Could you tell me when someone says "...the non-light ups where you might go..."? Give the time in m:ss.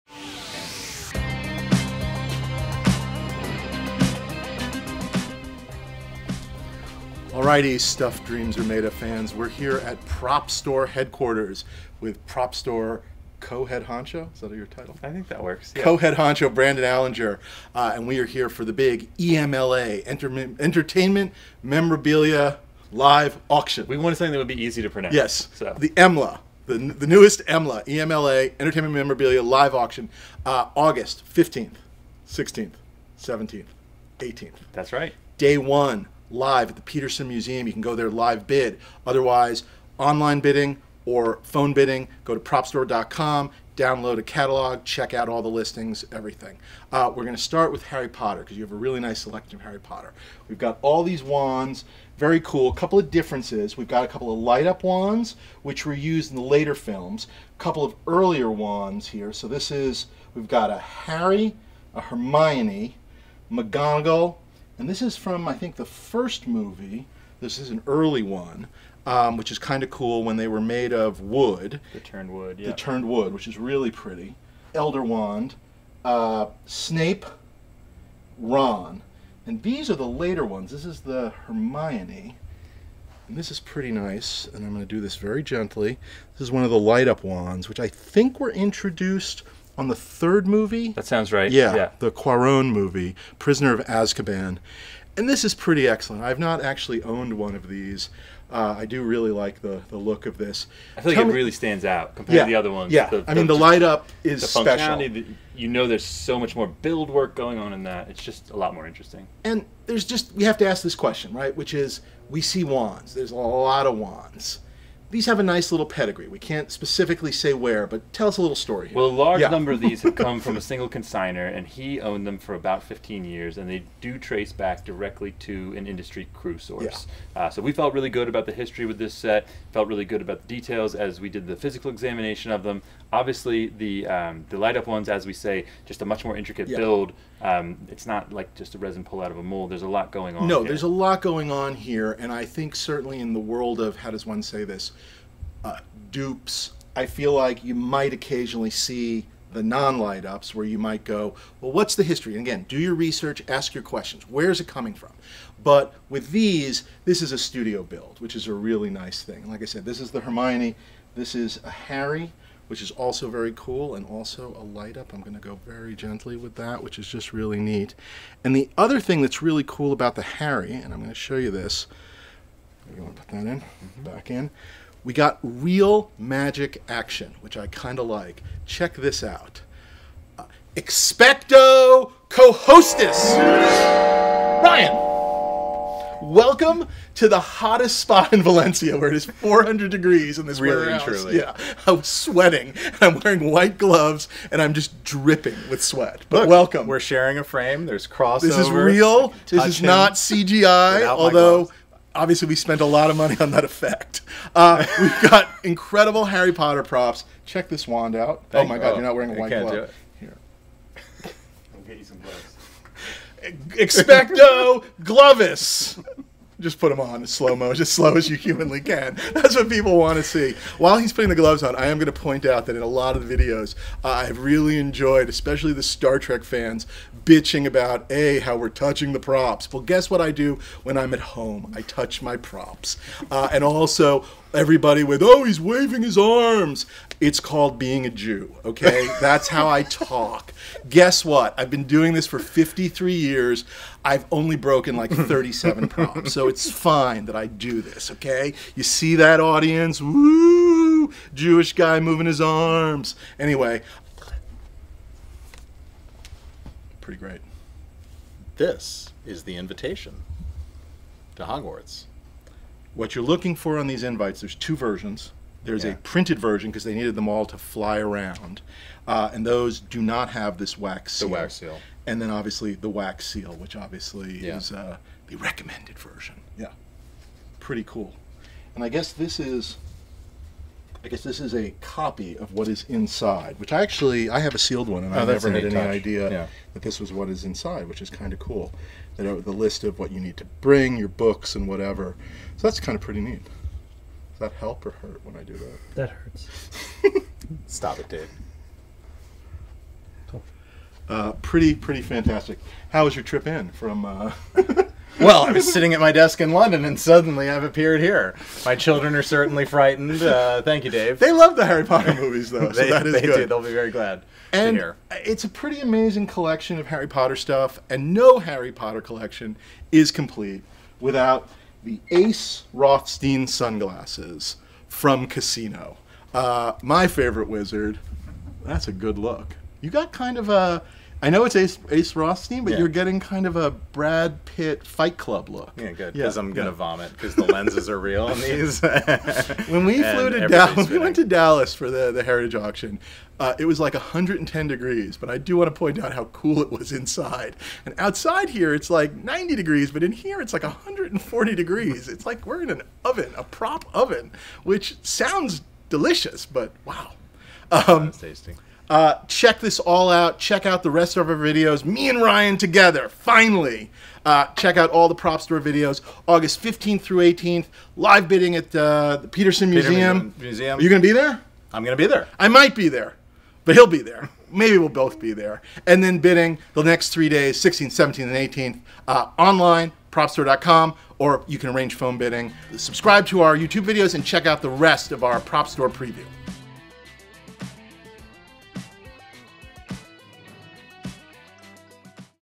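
2:29.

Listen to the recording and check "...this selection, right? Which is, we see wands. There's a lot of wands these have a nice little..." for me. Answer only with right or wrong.
wrong.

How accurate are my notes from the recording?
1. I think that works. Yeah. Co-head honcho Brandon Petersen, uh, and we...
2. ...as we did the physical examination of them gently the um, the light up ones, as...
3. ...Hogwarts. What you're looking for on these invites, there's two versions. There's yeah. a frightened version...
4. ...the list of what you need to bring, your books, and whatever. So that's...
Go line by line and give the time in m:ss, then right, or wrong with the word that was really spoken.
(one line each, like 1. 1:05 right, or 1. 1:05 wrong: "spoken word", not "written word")
1. 0:15 wrong: "Alinger", not "Petersen"
2. 2:10 wrong: "obviously", not "gently"
3. 4:21 wrong: "printed", not "frightened"
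4. 4:49 right.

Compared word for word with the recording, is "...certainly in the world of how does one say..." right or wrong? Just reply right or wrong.
right.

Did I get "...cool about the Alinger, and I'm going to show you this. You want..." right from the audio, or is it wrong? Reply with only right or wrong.
wrong.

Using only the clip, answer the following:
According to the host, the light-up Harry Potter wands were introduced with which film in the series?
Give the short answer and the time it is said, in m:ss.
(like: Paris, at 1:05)
Prisoner of Azkaban, at 1:33.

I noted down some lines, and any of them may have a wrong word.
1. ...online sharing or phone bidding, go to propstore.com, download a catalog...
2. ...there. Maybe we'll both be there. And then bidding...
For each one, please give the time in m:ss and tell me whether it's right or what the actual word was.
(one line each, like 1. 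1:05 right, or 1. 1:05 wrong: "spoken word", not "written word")
1. 0:39 wrong: "bidding", not "sharing"
2. 6:14 right.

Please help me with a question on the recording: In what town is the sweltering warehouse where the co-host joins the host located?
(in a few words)
Valencia.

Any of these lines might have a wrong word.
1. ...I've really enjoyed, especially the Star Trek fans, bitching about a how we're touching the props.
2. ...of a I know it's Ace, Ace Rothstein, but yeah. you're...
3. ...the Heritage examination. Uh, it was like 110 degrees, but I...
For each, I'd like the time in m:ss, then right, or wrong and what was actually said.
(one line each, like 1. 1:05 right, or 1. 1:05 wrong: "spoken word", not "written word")
1. 3:44 right
2. 5:30 right
3. 5:42 wrong: "auction", not "examination".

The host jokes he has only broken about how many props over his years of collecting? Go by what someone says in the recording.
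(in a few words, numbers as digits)
37.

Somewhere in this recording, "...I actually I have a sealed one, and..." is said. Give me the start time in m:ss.
4:43.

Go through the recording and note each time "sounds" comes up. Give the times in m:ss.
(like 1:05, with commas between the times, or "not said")
1:31, 5:55.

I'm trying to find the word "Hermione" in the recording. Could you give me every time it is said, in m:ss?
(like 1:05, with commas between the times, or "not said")
1:02, 1:21, 2:40.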